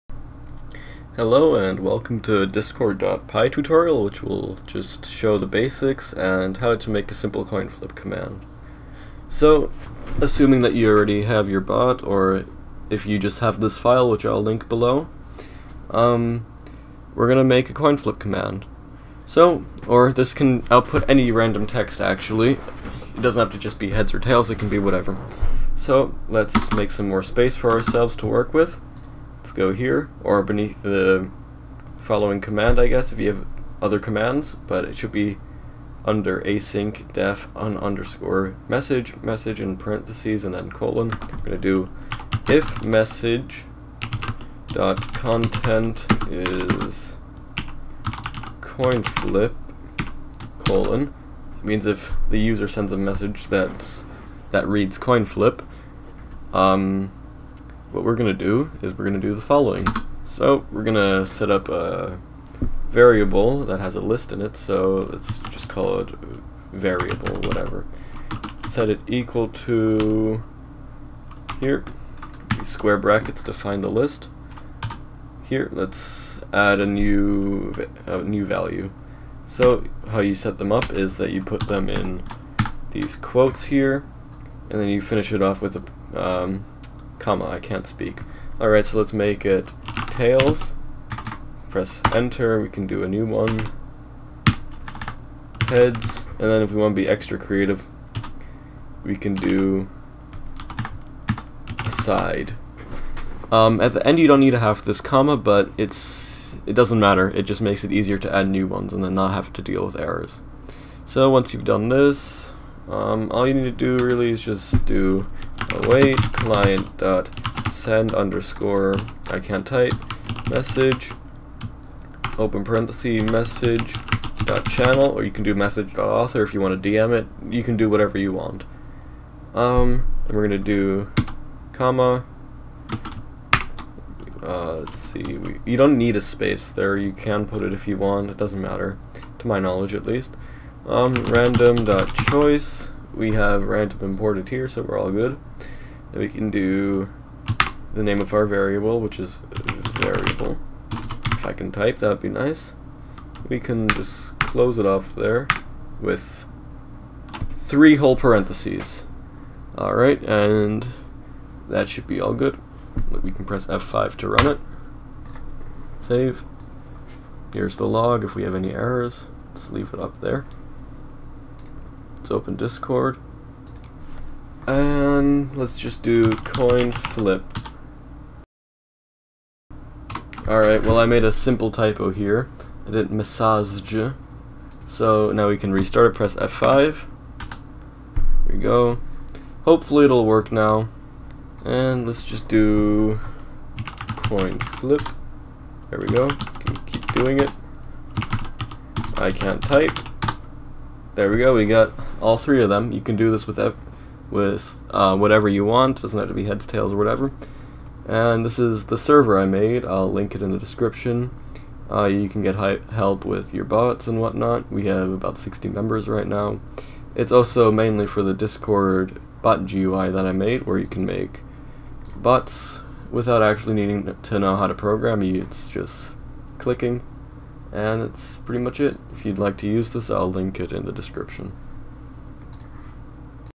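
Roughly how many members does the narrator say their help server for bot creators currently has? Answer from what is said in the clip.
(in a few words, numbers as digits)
60.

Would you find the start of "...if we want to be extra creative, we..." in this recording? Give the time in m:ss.
1:36.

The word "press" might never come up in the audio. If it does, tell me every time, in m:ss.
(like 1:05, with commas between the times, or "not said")
1:31, 2:43, 3:06.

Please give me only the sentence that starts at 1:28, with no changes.
Alright, so let's make it tails.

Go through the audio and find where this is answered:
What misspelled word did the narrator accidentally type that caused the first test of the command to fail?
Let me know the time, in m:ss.
3:03.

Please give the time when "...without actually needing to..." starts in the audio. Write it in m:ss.
3:43.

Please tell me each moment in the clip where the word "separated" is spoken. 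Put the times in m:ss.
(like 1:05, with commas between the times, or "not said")
not said.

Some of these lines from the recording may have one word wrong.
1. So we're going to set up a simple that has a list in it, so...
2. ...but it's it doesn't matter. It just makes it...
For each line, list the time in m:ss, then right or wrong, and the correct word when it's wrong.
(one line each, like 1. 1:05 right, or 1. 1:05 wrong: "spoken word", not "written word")
1. 1:00 wrong: "variable", not "simple"
2. 1:45 right.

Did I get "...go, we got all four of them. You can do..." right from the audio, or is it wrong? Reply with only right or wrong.
wrong.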